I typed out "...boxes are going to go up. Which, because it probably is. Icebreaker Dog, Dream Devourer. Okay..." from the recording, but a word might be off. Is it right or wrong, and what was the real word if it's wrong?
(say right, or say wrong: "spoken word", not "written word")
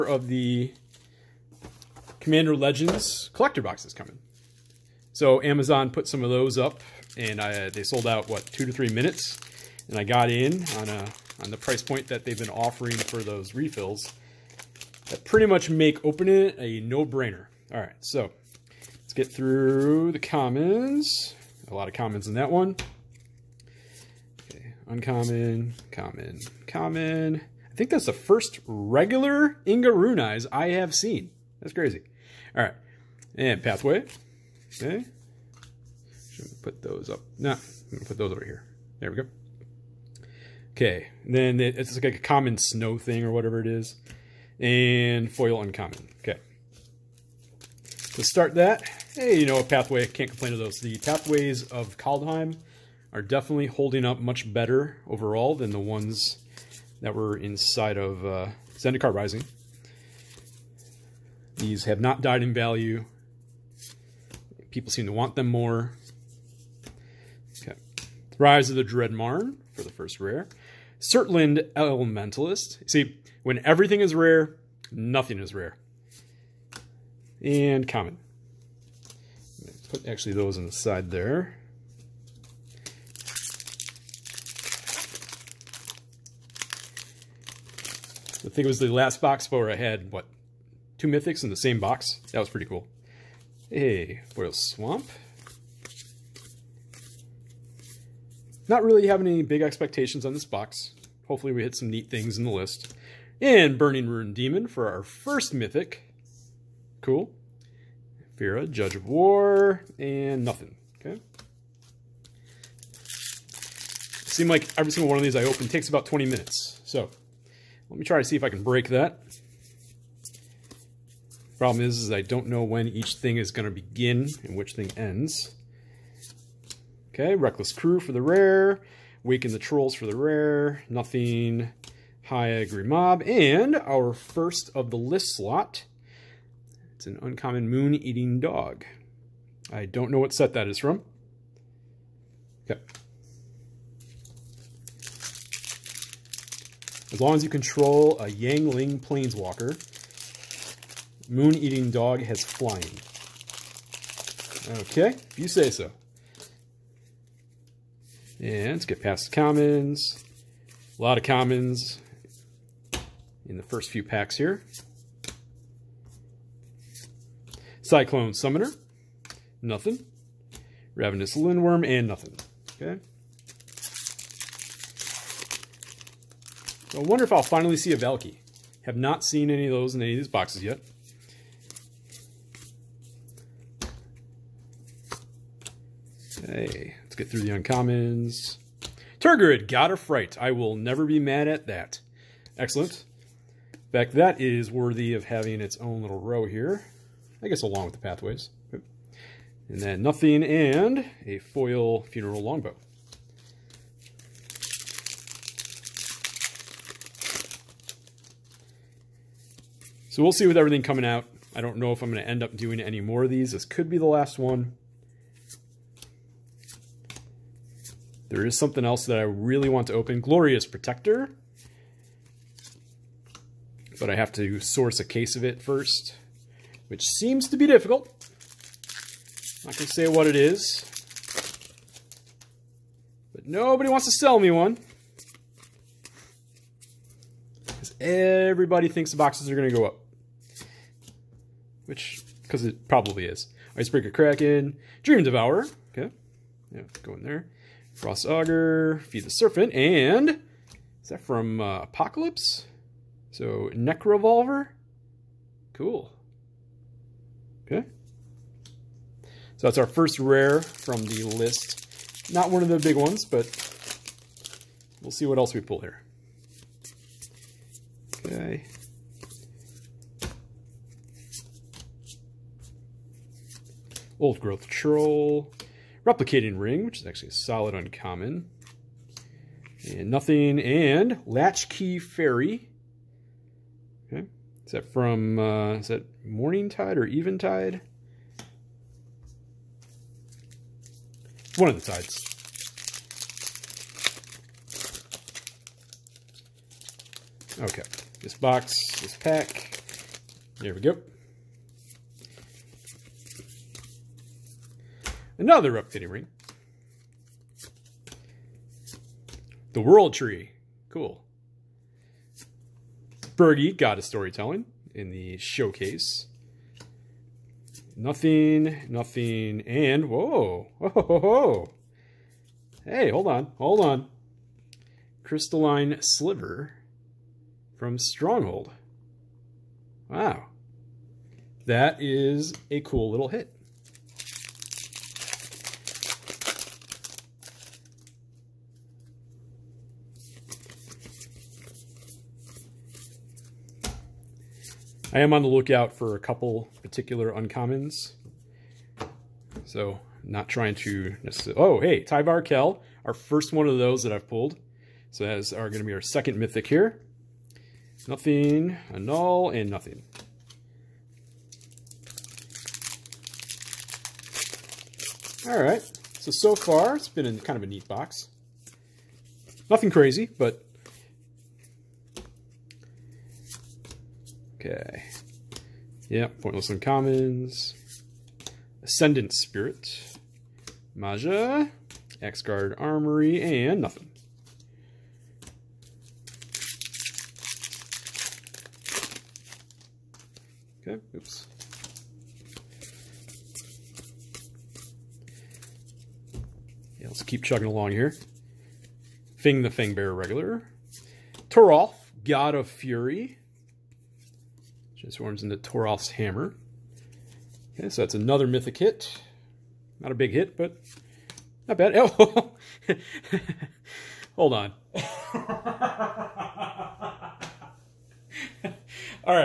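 wrong: "Kraken", not "Dog".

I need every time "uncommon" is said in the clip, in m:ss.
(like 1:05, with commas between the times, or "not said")
0:24, 0:45, 2:17, 3:07, 4:37, 5:47, 6:16.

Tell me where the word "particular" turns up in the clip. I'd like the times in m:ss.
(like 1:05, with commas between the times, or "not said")
5:46.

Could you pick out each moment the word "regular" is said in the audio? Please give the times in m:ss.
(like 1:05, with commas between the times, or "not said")
0:28, 6:40.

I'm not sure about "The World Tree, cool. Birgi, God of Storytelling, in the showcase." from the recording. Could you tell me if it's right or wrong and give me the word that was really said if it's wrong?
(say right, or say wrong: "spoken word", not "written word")
right.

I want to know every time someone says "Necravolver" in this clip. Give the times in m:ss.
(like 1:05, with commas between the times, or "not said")
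4:13.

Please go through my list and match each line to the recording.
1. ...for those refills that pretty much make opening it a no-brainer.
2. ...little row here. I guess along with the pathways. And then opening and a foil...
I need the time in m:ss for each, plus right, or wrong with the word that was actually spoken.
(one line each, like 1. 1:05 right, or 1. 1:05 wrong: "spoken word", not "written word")
1. 0:12 right
2. 3:16 wrong: "nothing", not "opening".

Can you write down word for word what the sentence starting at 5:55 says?
So that's are going to be our second mythic here.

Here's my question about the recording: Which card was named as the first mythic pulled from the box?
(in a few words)
Burning Rune Demon.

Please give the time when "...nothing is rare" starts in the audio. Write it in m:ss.
1:14.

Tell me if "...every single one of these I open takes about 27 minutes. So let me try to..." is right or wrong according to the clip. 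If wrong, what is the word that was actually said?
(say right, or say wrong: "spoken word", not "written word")
wrong: "20", not "27".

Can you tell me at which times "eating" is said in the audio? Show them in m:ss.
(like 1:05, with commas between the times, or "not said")
2:17, 2:31.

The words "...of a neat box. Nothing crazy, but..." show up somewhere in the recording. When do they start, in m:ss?
6:07.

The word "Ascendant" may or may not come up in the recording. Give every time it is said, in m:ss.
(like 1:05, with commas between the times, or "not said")
6:18.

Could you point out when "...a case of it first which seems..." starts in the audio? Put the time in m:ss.
3:44.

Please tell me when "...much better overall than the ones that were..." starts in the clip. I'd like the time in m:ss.
0:54.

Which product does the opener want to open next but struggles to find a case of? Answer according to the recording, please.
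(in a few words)
Glorious Protector.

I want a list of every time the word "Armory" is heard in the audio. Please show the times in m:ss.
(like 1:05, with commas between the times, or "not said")
6:22.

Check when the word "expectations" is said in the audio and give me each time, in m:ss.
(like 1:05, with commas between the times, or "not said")
1:39.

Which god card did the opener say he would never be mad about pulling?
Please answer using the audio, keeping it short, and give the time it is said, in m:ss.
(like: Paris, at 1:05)
Tergrid, God of Fright, at 3:09.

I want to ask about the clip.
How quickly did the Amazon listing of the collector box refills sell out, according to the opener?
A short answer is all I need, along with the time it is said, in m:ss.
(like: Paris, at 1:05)
2 to 3 minutes, at 0:08.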